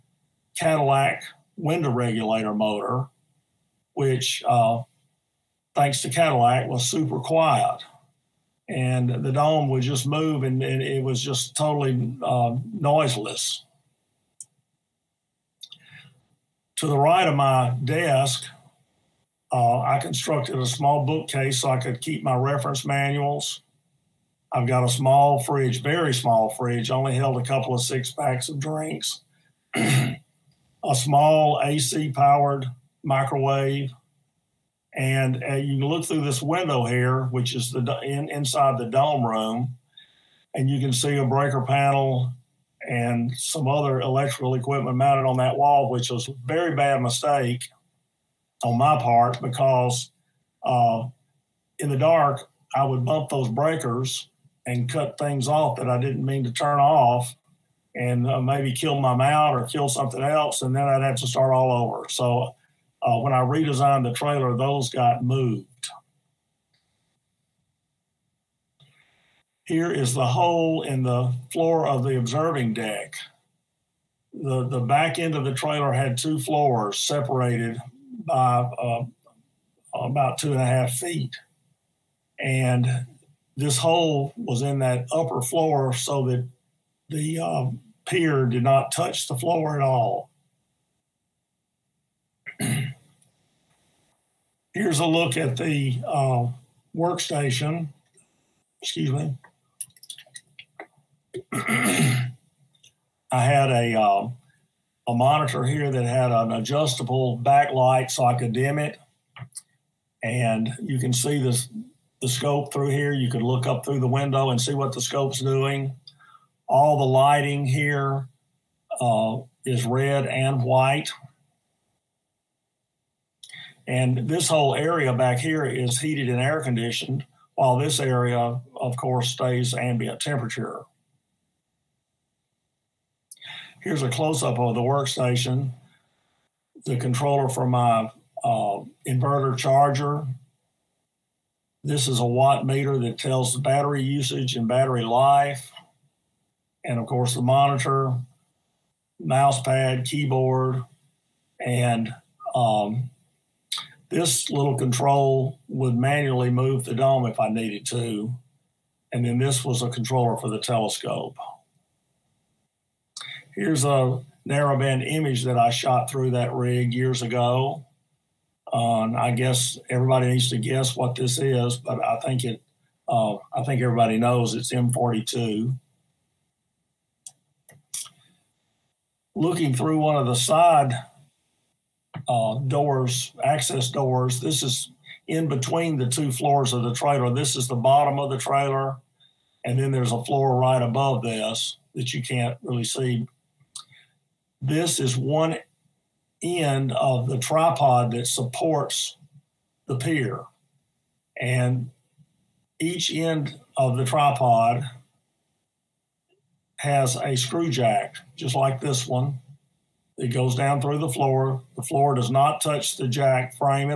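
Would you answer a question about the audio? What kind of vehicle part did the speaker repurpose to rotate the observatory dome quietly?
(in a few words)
Cadillac window regulator motor.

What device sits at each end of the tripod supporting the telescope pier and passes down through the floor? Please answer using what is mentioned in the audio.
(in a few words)
screw jack.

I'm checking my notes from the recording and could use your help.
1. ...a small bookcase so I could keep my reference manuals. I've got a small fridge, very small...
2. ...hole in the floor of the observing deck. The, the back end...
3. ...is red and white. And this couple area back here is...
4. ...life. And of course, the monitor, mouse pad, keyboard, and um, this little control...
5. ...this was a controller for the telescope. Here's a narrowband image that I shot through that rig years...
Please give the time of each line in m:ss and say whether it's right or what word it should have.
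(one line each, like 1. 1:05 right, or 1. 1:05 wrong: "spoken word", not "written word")
1. 0:20 right
2. 1:10 right
3. 1:59 wrong: "whole", not "couple"
4. 2:25 right
5. 2:39 right.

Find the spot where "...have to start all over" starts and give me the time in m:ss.
1:01.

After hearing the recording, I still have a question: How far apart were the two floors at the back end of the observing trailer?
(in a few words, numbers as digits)
2.5 feet.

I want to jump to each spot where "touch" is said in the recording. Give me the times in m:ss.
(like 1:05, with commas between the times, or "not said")
1:28, 3:32.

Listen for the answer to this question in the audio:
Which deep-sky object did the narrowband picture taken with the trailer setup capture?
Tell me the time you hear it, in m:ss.
2:54.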